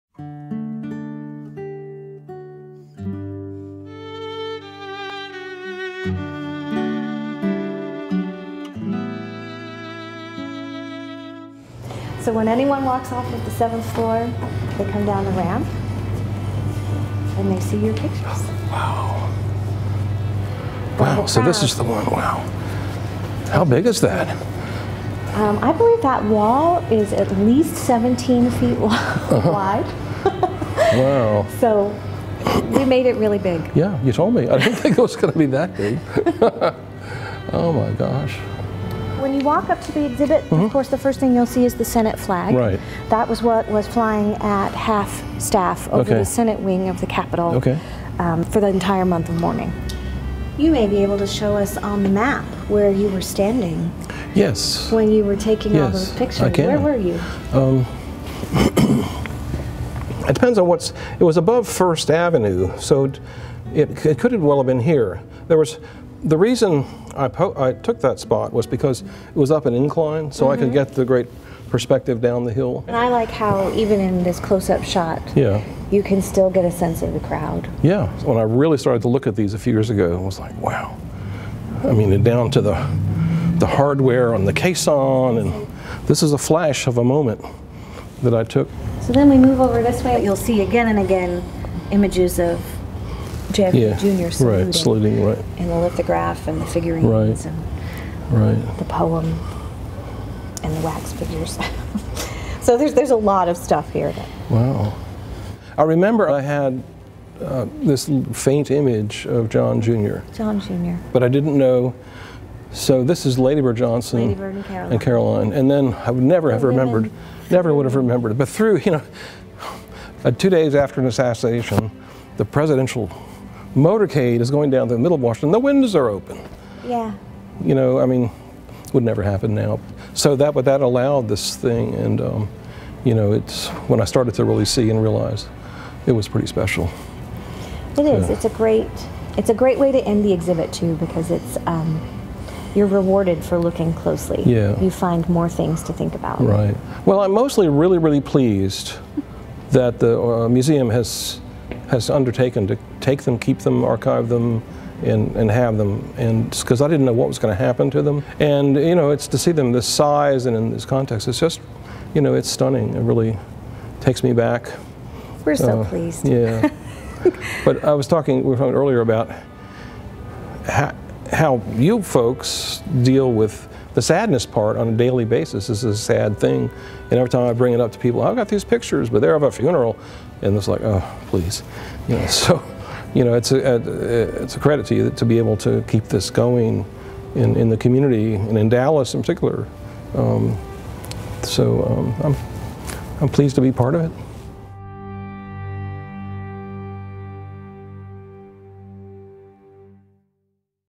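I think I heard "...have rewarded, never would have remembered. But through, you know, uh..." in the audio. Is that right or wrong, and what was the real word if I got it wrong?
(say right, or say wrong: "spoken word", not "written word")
wrong: "remembered", not "rewarded".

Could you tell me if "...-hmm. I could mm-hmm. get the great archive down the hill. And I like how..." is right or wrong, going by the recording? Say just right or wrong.
wrong.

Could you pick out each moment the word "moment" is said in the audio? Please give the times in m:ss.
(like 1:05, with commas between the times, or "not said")
1:27.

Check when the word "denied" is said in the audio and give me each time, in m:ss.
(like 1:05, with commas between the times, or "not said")
not said.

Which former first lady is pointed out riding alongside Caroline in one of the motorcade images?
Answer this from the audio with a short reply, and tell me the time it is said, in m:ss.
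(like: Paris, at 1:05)
Lady Bird Johnson, at 1:53.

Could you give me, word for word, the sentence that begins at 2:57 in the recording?
And every time I bring it up to people, I've got these pictures, but they're of a funeral.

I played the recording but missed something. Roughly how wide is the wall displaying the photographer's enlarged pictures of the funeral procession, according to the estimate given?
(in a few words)
17 feet.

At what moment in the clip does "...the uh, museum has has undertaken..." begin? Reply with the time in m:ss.
2:29.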